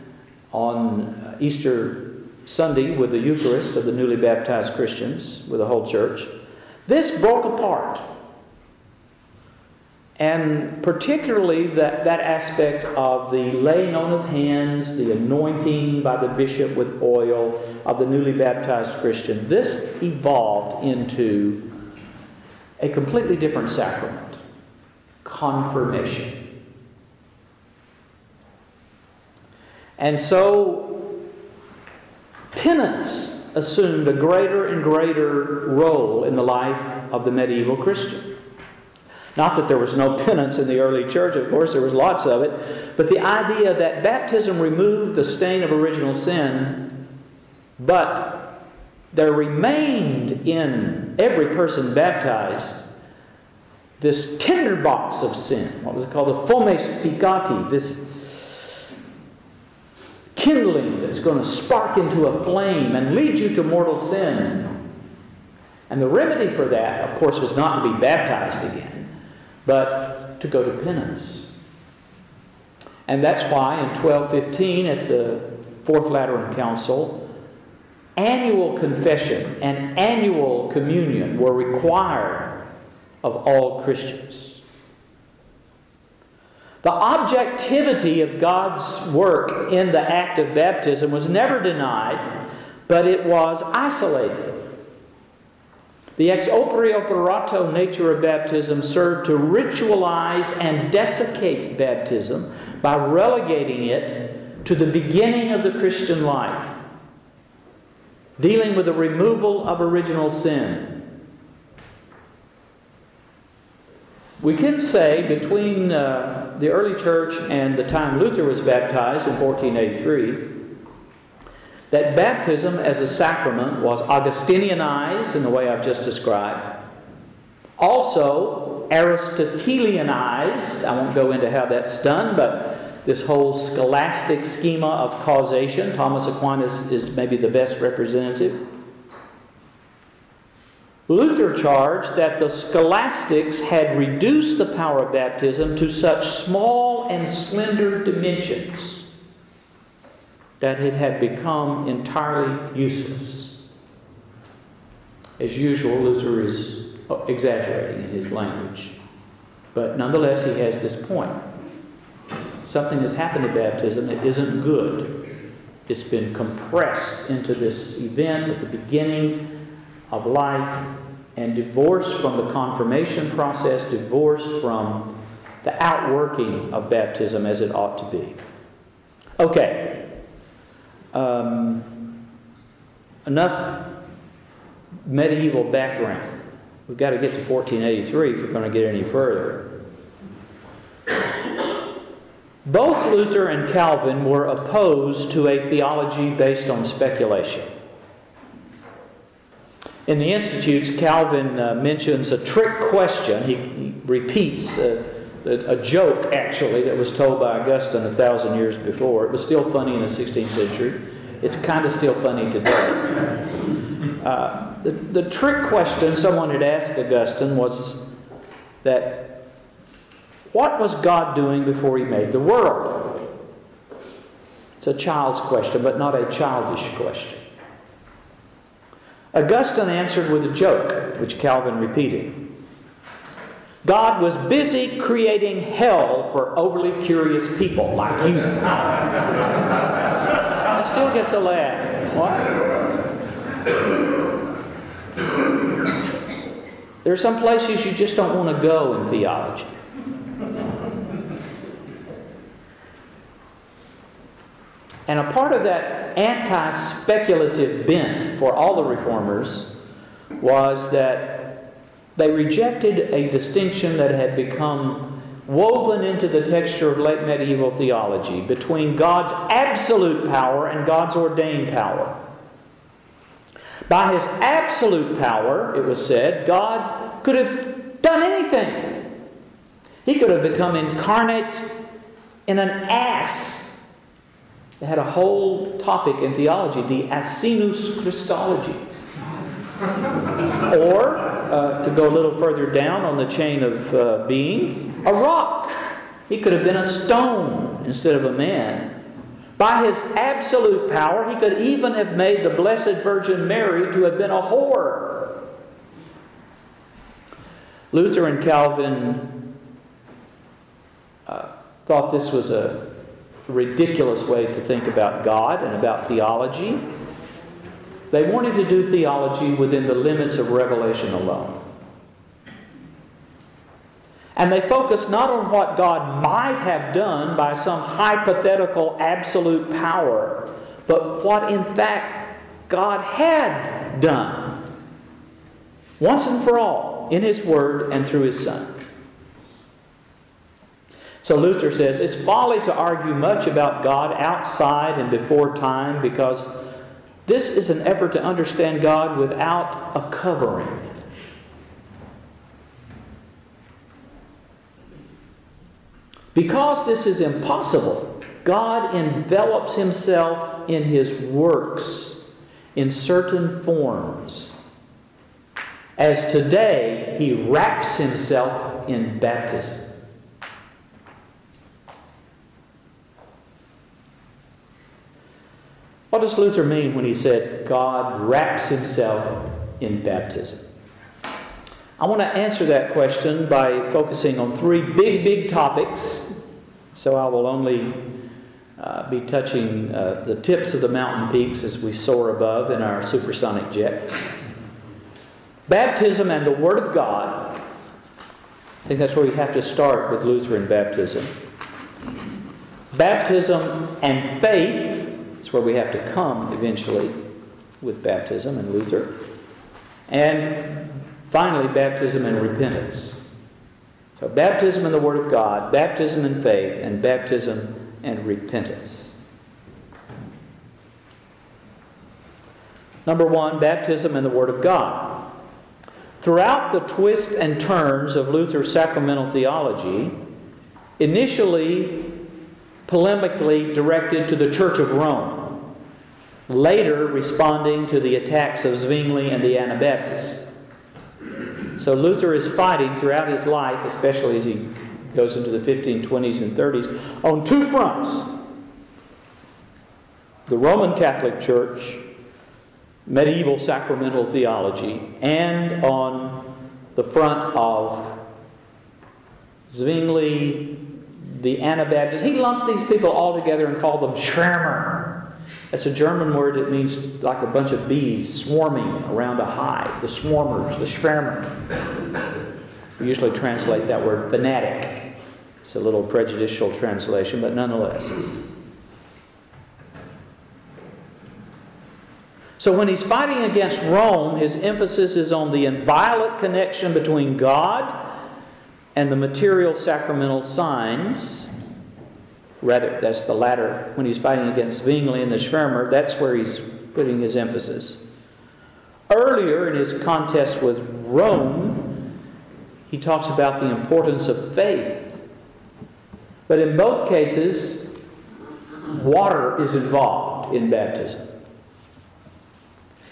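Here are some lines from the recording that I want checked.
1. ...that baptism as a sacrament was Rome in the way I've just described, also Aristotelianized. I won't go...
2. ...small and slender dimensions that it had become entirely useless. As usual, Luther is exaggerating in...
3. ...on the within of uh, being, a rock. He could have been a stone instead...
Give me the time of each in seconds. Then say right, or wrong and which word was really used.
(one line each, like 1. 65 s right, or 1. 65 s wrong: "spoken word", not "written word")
1. 121 s wrong: "Augustinianized", not "Rome"
2. 146 s right
3. 293 s wrong: "chain", not "within".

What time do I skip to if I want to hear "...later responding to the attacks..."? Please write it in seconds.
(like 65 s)
436 s.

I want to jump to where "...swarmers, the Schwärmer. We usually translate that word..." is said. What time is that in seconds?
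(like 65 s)
470 s.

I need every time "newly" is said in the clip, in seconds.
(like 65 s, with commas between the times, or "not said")
3 s, 18 s.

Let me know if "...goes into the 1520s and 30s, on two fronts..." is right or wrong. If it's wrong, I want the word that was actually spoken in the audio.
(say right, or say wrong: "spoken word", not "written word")
right.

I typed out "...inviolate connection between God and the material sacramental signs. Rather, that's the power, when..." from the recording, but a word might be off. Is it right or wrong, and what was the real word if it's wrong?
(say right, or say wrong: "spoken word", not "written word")
wrong: "latter", not "power".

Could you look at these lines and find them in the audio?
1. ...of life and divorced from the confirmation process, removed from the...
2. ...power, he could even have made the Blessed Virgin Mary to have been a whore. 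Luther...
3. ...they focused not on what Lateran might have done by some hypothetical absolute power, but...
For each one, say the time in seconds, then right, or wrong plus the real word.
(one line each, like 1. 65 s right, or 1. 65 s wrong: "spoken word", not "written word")
1. 170 s wrong: "divorced", not "removed"
2. 300 s right
3. 324 s wrong: "God", not "Lateran".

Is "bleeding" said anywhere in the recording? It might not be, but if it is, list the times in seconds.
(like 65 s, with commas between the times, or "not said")
not said.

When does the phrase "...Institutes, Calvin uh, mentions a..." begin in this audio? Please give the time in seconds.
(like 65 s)
200 s.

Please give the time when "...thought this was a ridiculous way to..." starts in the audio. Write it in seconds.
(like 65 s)
311 s.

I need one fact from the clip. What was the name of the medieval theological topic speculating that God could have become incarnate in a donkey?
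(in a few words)
Asinus Christology.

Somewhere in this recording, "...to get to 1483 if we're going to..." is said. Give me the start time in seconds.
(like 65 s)
187 s.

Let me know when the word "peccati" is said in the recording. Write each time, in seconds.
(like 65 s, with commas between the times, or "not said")
57 s.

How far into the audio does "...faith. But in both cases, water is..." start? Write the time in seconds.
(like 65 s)
504 s.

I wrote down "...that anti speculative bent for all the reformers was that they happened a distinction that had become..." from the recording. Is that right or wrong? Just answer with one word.
wrong.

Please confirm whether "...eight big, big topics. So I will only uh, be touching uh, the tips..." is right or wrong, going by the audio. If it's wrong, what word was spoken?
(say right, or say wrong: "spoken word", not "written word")
wrong: "three", not "eight".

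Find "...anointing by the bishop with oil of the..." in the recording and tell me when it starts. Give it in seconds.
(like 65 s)
15 s.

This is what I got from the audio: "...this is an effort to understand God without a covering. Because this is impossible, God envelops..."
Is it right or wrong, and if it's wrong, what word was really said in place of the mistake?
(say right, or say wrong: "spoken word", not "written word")
right.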